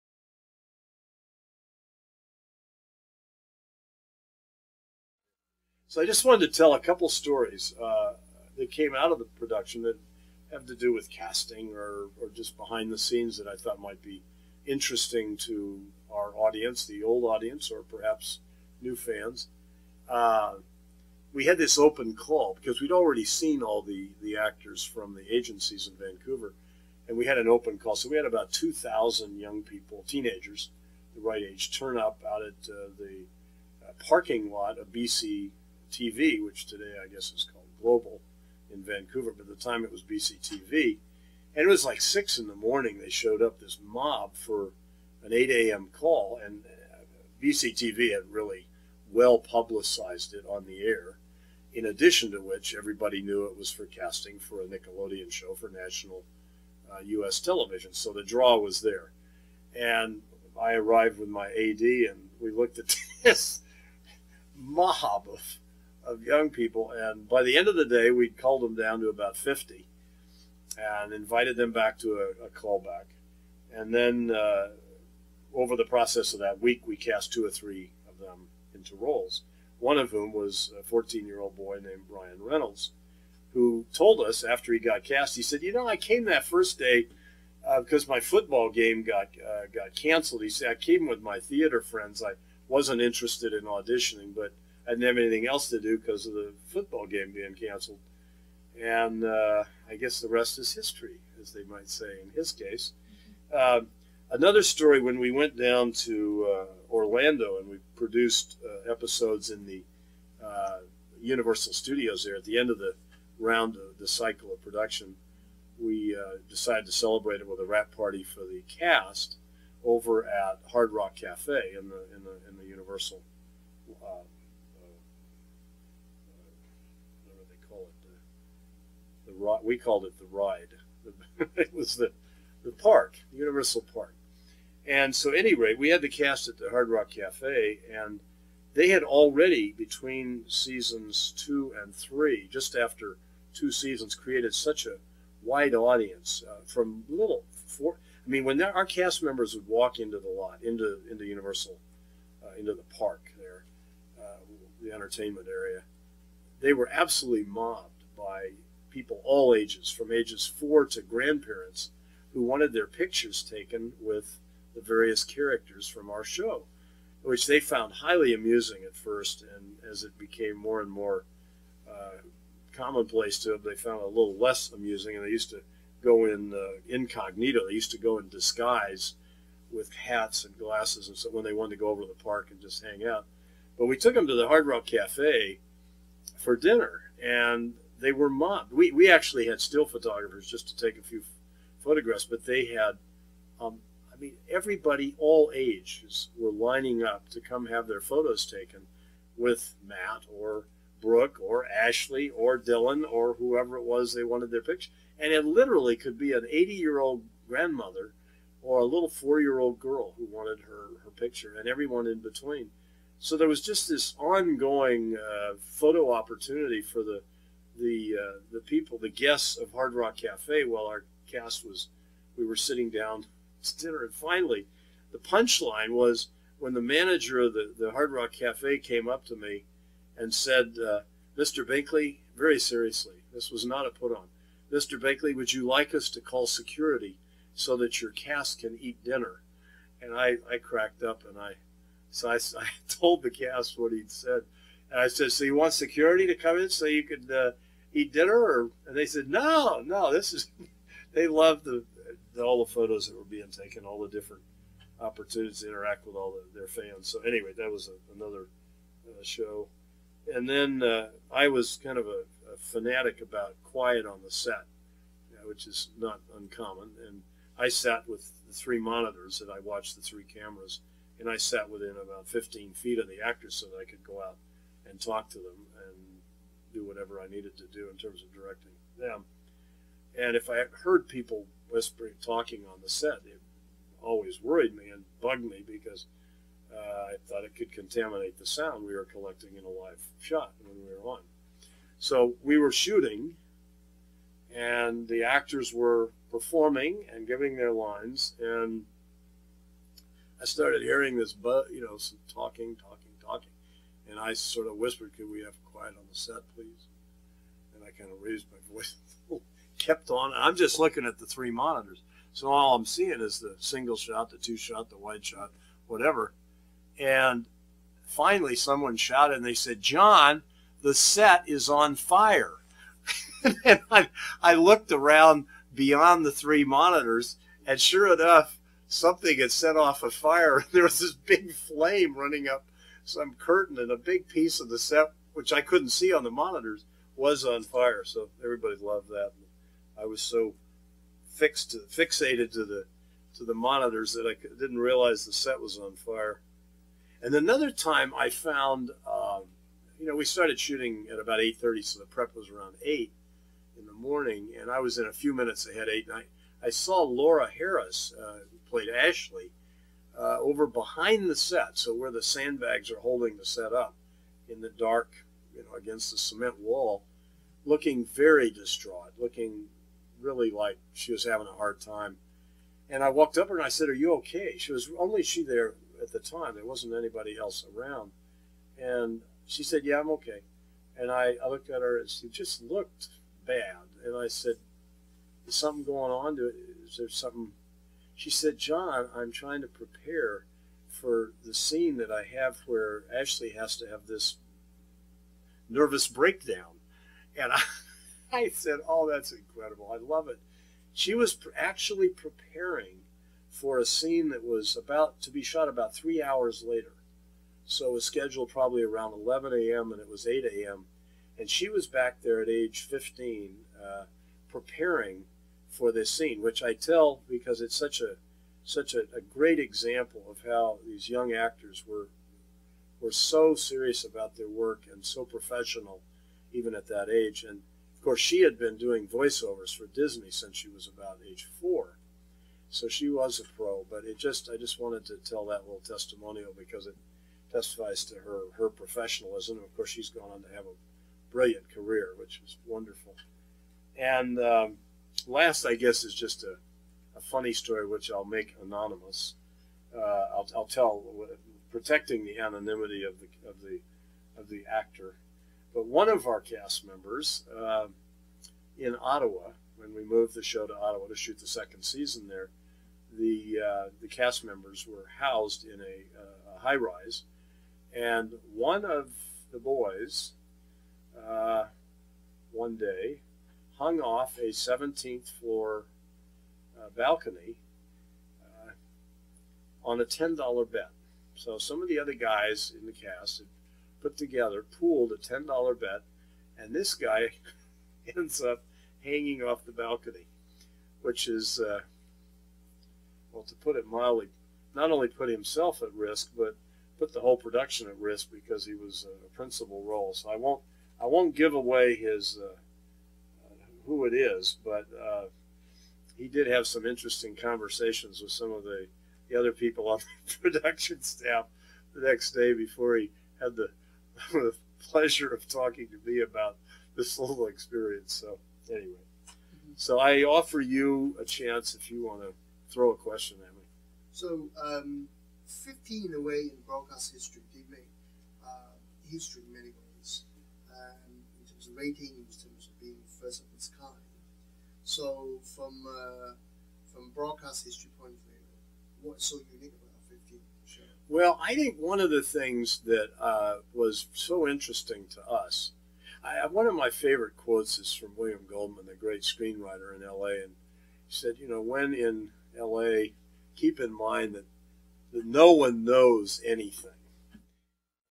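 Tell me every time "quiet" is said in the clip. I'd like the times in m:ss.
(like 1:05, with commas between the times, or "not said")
4:23, 5:05.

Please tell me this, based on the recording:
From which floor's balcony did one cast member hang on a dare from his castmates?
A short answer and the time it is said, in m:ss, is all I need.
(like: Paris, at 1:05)
17th floor, at 7:54.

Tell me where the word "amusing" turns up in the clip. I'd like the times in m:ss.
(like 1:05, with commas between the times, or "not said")
2:48, 2:54.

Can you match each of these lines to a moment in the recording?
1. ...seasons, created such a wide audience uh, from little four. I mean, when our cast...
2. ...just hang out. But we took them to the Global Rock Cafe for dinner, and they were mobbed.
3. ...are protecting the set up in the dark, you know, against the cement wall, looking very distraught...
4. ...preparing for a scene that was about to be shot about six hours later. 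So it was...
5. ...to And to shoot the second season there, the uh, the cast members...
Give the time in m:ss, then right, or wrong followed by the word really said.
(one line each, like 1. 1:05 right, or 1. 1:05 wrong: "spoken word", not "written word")
1. 2:23 right
2. 3:02 wrong: "Hard", not "Global"
3. 6:02 wrong: "holding", not "protecting"
4. 6:42 wrong: "three", not "six"
5. 7:40 wrong: "Ottawa", not "And".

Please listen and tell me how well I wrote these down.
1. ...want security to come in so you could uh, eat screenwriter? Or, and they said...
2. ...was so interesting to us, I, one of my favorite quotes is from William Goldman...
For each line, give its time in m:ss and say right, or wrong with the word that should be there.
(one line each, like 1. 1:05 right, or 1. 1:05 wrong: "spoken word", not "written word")
1. 4:05 wrong: "dinner", not "screenwriter"
2. 9:03 right.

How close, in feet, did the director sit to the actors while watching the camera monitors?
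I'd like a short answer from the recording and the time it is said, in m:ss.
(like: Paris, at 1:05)
15 feet, at 4:32.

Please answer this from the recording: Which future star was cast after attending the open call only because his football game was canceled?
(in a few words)
Ryan Reynolds.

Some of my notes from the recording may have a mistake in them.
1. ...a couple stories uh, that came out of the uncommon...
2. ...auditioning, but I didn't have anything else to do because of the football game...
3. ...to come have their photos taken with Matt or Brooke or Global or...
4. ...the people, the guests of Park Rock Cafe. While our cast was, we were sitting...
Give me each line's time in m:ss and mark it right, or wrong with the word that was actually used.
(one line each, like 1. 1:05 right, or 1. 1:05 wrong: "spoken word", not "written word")
1. 0:06 wrong: "production", not "uncommon"
2. 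1:33 right
3. 3:17 wrong: "Ashley", not "Global"
4. 3:38 wrong: "Hard", not "Park".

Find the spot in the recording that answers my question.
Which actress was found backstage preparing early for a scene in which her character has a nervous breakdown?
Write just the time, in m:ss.
5:57.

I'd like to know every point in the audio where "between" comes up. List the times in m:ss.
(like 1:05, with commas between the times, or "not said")
2:19, 3:32.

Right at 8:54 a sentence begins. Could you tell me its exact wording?
So from uh, from broadcast history point of view, what's so unique about 15 show?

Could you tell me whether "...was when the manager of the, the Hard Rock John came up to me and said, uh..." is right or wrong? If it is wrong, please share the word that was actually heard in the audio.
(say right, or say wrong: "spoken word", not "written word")
wrong: "Cafe", not "John".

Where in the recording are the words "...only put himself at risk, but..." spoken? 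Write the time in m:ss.
8:14.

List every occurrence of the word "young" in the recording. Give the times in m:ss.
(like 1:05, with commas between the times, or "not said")
0:29, 1:06, 7:01.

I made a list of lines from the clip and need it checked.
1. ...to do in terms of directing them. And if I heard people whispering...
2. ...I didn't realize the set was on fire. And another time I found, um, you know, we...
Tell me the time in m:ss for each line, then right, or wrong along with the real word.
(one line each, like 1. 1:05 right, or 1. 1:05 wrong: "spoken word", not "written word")
1. 4:37 right
2. 5:44 right.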